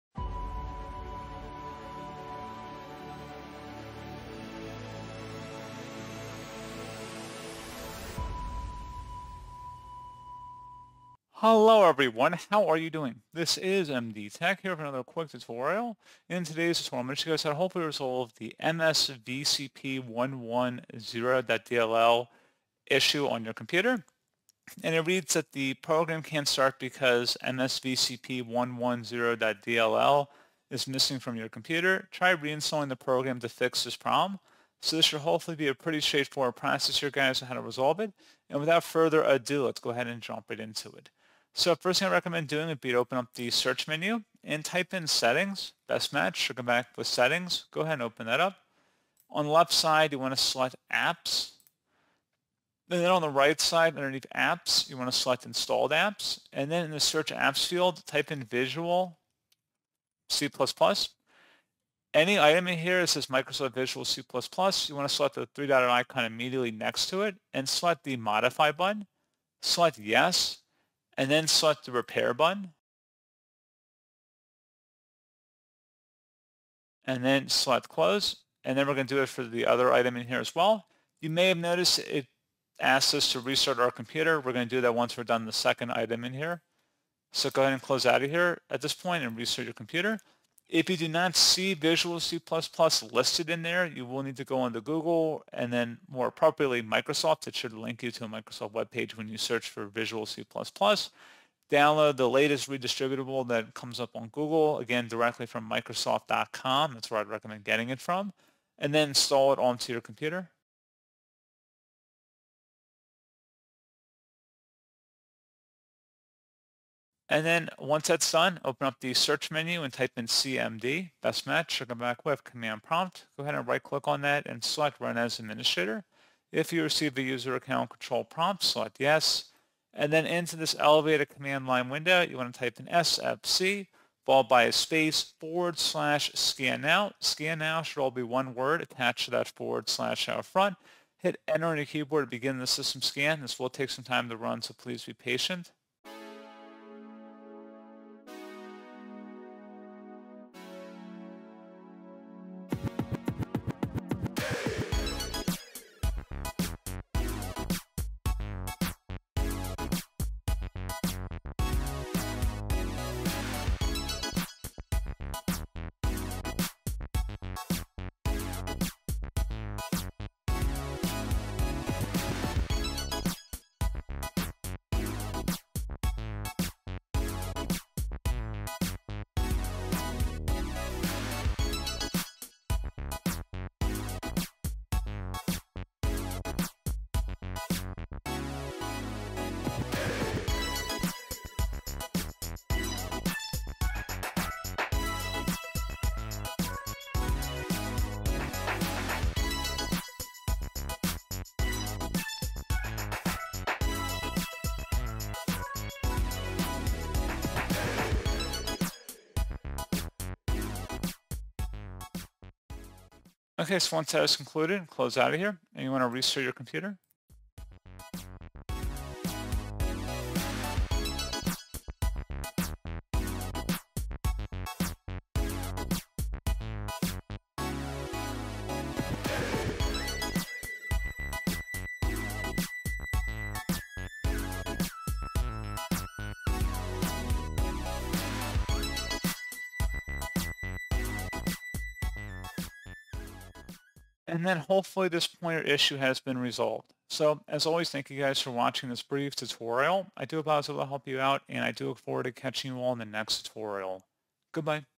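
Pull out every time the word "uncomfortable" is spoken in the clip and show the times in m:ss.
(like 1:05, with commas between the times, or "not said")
not said.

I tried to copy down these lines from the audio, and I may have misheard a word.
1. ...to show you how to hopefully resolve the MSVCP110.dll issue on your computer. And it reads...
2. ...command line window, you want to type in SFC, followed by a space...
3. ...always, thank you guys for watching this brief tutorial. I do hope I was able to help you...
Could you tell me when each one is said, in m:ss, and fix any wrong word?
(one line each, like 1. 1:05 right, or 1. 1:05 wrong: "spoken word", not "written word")
1. 0:17 right
2. 2:11 right
3. 4:07 right.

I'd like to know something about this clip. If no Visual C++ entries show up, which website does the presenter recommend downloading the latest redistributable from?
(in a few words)
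Microsoft.com.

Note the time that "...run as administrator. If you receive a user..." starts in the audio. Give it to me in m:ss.
2:04.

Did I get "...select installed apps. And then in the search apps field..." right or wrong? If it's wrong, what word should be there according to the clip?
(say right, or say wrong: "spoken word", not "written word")
right.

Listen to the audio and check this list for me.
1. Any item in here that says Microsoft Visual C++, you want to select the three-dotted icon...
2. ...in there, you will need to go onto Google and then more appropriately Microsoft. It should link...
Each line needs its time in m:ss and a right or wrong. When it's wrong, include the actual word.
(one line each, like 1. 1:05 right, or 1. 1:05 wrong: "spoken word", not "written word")
1. 1:02 right
2. 1:33 right.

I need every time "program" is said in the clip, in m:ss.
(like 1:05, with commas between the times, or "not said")
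0:25, 0:32.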